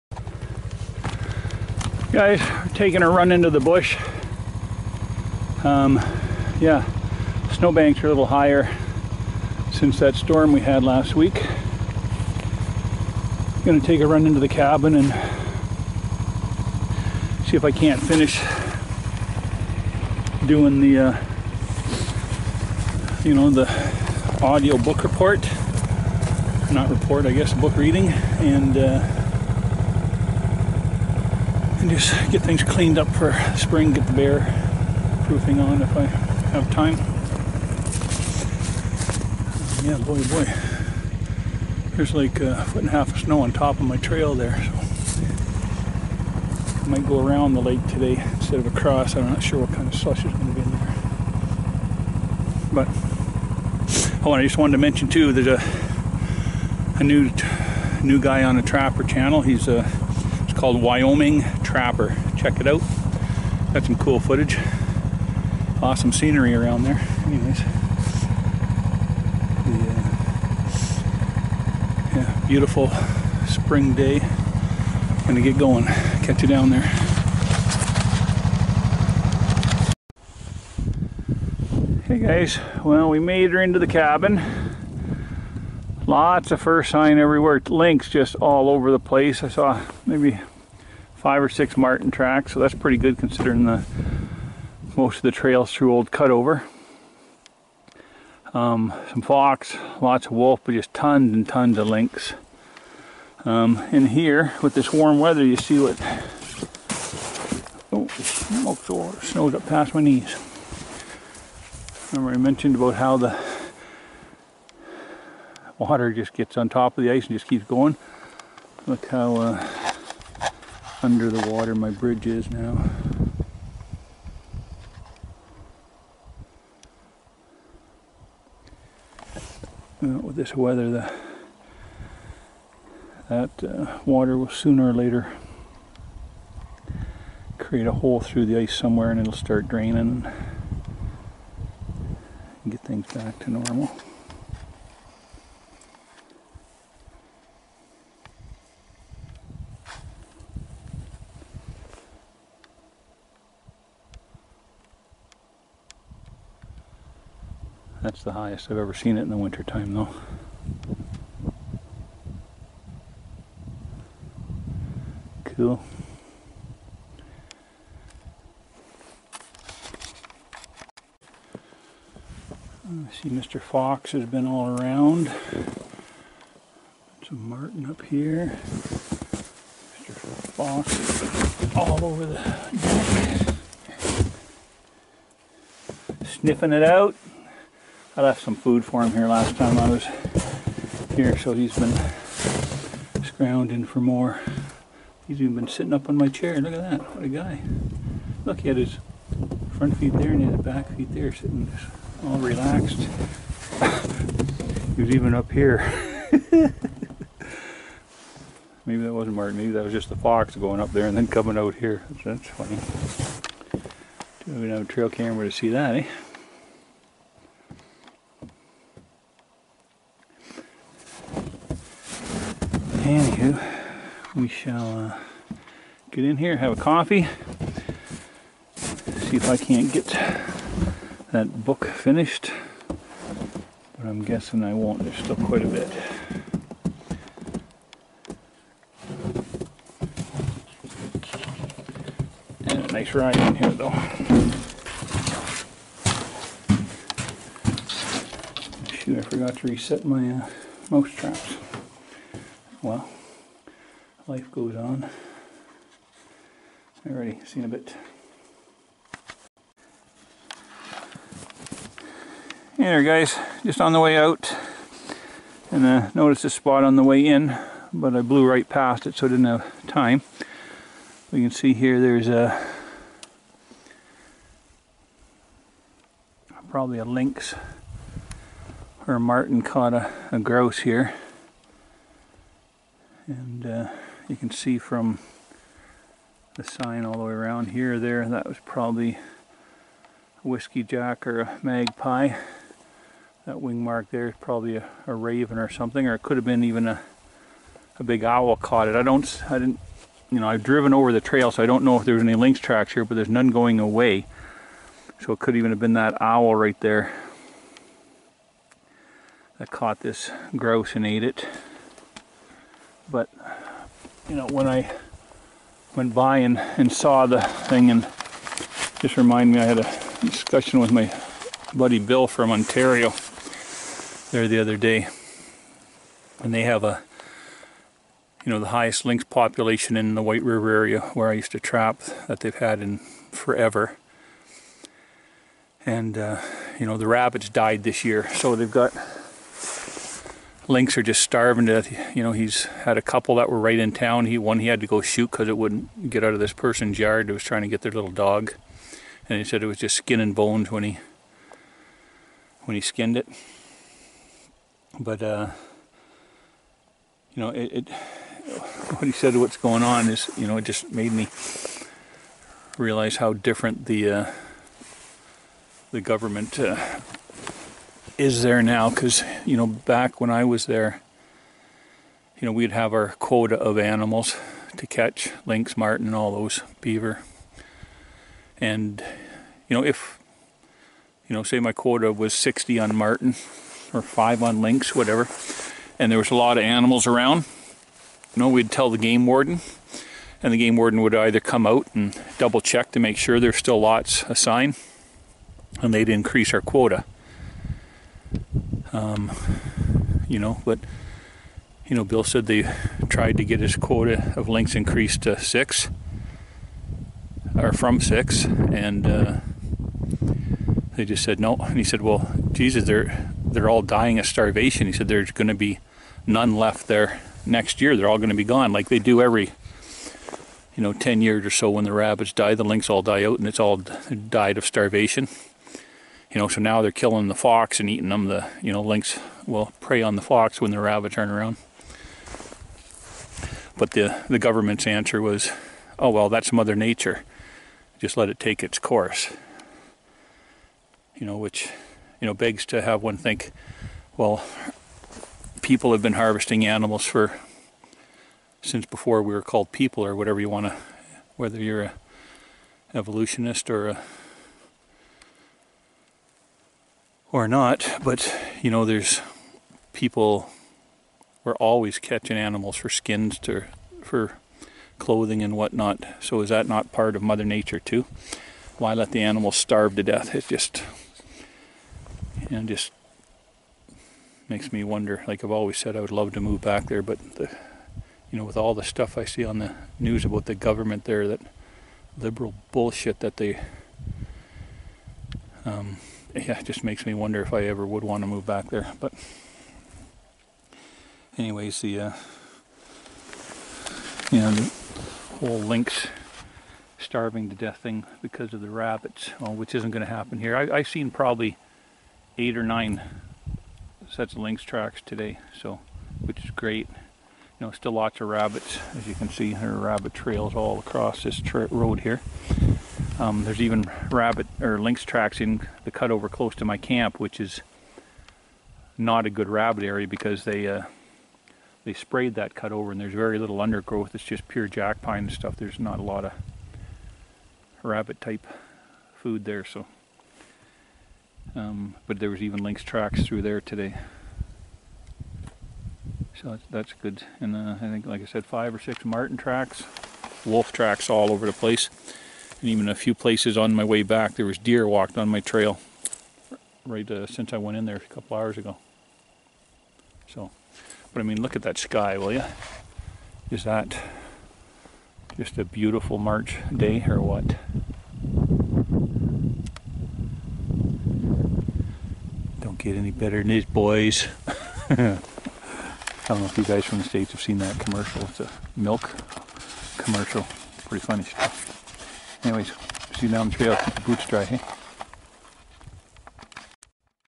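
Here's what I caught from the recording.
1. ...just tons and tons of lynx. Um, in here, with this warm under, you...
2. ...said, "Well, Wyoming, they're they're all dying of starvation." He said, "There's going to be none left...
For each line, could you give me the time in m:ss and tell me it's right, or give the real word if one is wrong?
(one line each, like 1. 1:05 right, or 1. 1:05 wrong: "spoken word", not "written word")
1. 1:40 wrong: "weather", not "under"
2. 6:51 wrong: "Jesus", not "Wyoming".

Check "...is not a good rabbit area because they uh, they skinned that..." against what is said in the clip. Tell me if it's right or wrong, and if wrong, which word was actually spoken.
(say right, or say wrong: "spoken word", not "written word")
wrong: "sprayed", not "skinned".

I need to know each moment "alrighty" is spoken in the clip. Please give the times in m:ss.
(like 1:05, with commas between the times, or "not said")
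not said.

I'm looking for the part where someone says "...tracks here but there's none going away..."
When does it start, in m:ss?
5:02.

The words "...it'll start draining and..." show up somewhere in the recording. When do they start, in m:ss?
2:19.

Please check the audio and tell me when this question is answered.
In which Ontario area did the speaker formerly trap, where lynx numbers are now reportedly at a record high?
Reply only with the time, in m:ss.
5:30.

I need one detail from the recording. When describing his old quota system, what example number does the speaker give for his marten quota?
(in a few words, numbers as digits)
60.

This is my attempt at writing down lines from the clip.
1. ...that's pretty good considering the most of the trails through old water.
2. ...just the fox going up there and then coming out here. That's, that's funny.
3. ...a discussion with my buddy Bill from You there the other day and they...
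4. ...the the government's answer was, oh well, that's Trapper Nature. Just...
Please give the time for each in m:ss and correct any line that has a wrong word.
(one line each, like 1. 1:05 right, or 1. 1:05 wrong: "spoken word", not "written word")
1. 1:32 wrong: "cutover", not "water"
2. 3:29 right
3. 5:19 wrong: "Ontario", not "You"
4. 7:13 wrong: "Mother", not "Trapper".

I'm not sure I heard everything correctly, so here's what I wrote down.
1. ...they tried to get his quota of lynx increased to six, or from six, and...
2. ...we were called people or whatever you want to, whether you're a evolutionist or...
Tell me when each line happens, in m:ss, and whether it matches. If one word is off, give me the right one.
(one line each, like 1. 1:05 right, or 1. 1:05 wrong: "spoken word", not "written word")
1. 6:42 right
2. 7:29 right.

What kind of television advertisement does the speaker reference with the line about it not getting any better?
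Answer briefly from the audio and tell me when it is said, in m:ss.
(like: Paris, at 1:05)
milk commercial, at 9:28.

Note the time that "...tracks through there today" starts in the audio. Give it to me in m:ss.
8:52.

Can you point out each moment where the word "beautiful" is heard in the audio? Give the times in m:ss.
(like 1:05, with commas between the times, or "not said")
1:12, 9:15.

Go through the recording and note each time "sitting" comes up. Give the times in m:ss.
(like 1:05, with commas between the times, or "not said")
3:15, 3:21.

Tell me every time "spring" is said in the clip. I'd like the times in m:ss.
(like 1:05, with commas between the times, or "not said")
0:33, 1:13.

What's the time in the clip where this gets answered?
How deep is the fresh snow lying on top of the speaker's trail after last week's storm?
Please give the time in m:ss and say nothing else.
0:42.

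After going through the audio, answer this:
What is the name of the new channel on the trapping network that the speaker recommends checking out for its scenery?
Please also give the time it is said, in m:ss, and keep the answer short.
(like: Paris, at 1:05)
Wyoming Trapper, at 1:00.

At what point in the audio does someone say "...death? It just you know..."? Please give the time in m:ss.
7:50.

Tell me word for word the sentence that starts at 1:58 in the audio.
Look how uh, under the water my bridge is now.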